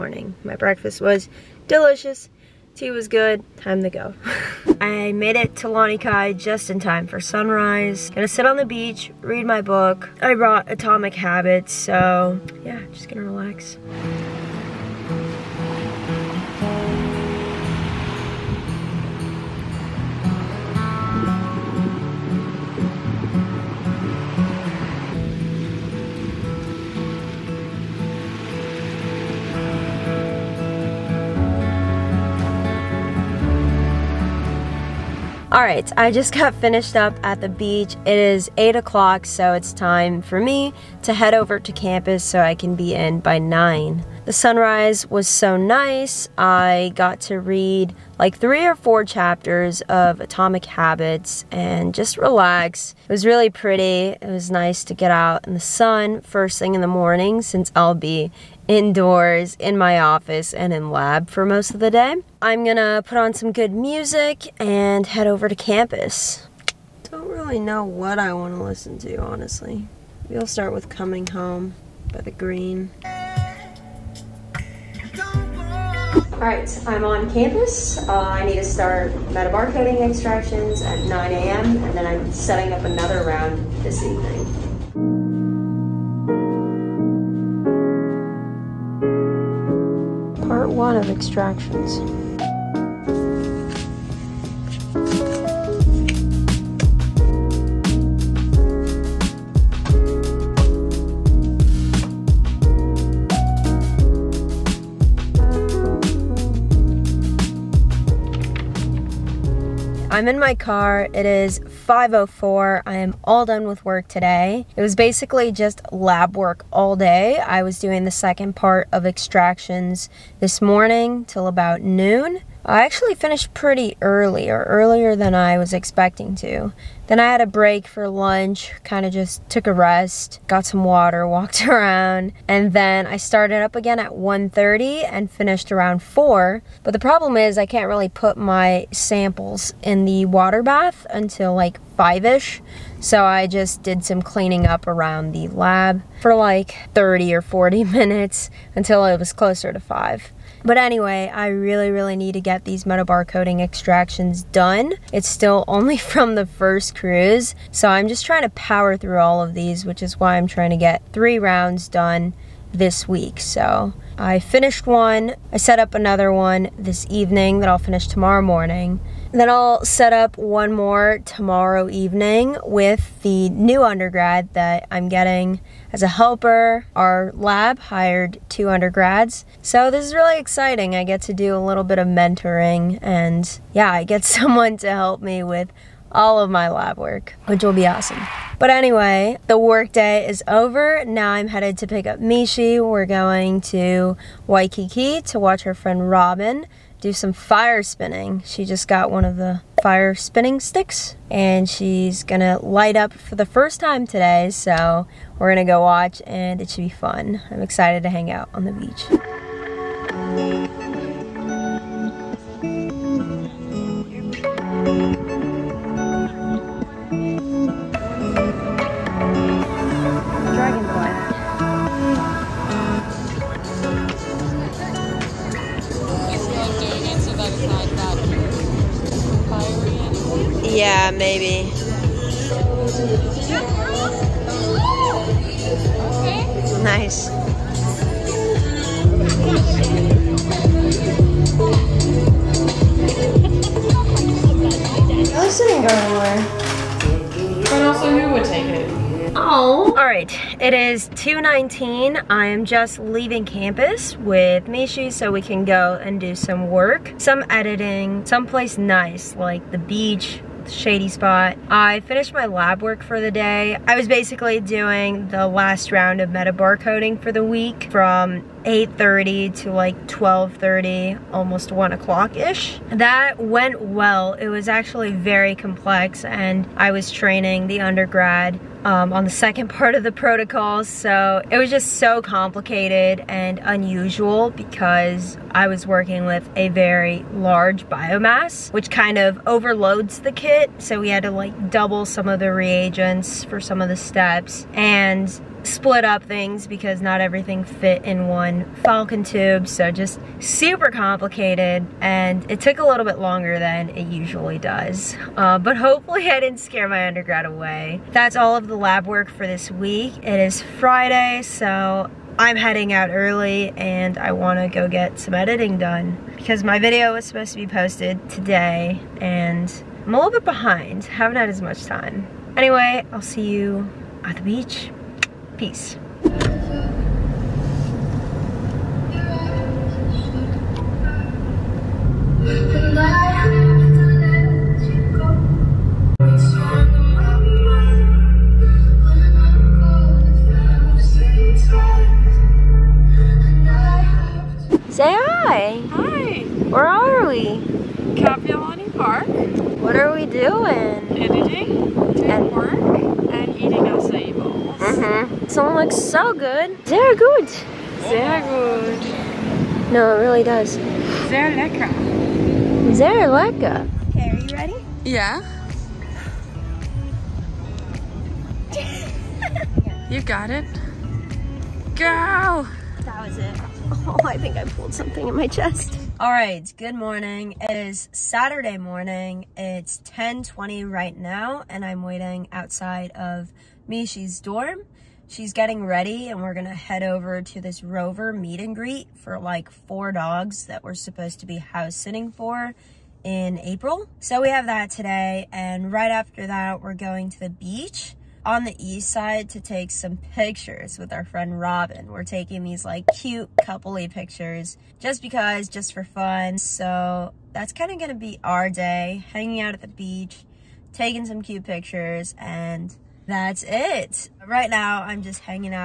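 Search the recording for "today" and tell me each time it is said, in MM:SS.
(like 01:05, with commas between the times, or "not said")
01:54, 03:24, 05:18, 06:34.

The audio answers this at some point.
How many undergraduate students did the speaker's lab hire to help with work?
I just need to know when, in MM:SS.
02:58.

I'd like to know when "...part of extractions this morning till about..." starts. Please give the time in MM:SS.
01:58.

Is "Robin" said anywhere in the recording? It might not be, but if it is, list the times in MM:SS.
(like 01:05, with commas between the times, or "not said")
03:16, 06:41.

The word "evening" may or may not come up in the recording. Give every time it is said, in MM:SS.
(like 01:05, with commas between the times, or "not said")
01:24, 02:47, 02:51.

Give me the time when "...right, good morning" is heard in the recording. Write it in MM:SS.
06:16.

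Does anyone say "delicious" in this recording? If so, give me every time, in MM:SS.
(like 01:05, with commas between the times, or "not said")
00:01.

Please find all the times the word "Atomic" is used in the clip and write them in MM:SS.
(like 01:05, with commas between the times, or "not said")
00:10, 00:50.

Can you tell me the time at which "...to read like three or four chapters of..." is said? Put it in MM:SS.
00:47.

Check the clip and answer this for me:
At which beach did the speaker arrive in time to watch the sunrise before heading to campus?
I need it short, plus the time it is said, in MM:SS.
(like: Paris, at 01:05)
Lanikai, at 00:05.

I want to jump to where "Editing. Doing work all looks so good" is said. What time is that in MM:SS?
05:51.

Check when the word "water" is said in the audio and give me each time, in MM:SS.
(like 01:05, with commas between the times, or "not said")
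02:10, 02:20.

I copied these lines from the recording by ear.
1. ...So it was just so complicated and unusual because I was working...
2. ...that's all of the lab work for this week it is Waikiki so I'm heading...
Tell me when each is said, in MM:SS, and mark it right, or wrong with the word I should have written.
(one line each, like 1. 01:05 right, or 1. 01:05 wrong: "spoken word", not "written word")
1. 04:40 right
2. 05:08 wrong: "Friday", not "Waikiki".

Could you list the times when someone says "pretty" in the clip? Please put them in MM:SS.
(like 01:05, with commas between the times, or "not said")
00:53, 02:03.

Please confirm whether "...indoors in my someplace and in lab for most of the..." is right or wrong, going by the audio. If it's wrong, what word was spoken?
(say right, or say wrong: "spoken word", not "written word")
wrong: "office", not "someplace".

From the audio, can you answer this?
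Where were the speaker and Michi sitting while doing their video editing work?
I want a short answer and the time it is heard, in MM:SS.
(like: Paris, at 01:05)
Kapiolani Park, at 05:48.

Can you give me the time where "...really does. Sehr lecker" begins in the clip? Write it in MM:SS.
06:00.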